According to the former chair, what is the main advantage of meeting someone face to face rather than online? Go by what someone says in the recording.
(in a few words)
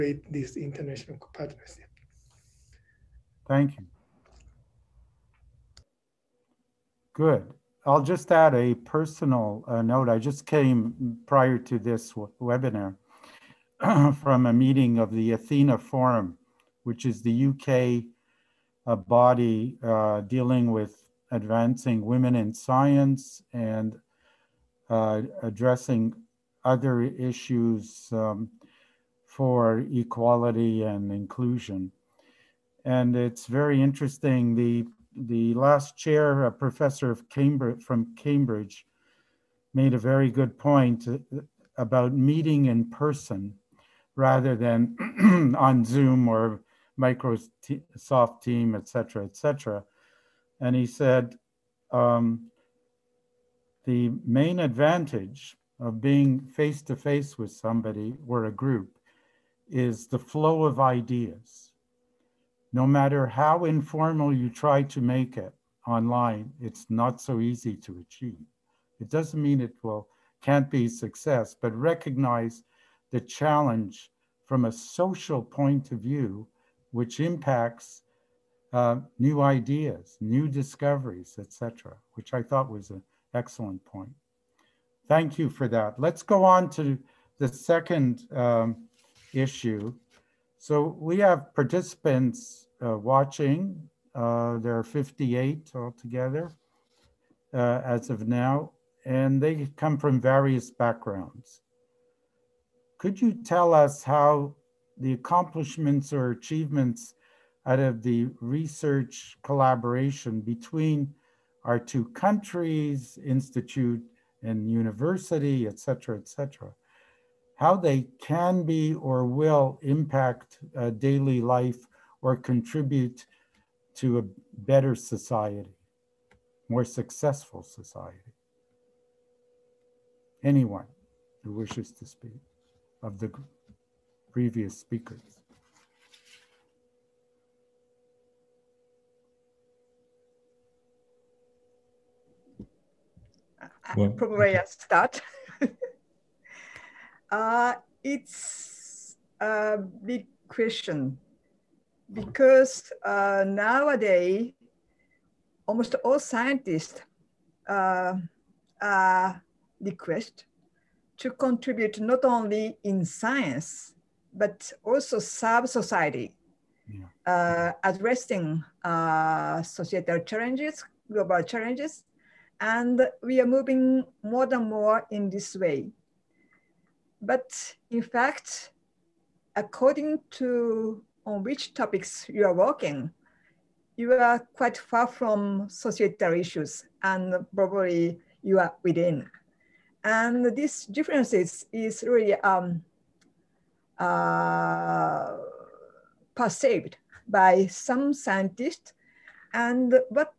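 The flow of ideas.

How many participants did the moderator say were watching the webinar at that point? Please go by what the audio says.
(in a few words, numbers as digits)
58.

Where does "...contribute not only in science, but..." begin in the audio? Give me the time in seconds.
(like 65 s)
161 s.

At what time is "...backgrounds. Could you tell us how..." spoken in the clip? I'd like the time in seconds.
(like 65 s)
100 s.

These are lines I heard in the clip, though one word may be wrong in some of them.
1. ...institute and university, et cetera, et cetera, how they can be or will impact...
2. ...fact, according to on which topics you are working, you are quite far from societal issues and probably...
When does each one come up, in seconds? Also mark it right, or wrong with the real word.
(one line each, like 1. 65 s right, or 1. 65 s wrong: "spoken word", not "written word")
1. 113 s right
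2. 178 s right.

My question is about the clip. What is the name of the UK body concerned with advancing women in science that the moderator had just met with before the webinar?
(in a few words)
Athena Forum.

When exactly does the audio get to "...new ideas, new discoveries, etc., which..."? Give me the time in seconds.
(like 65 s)
79 s.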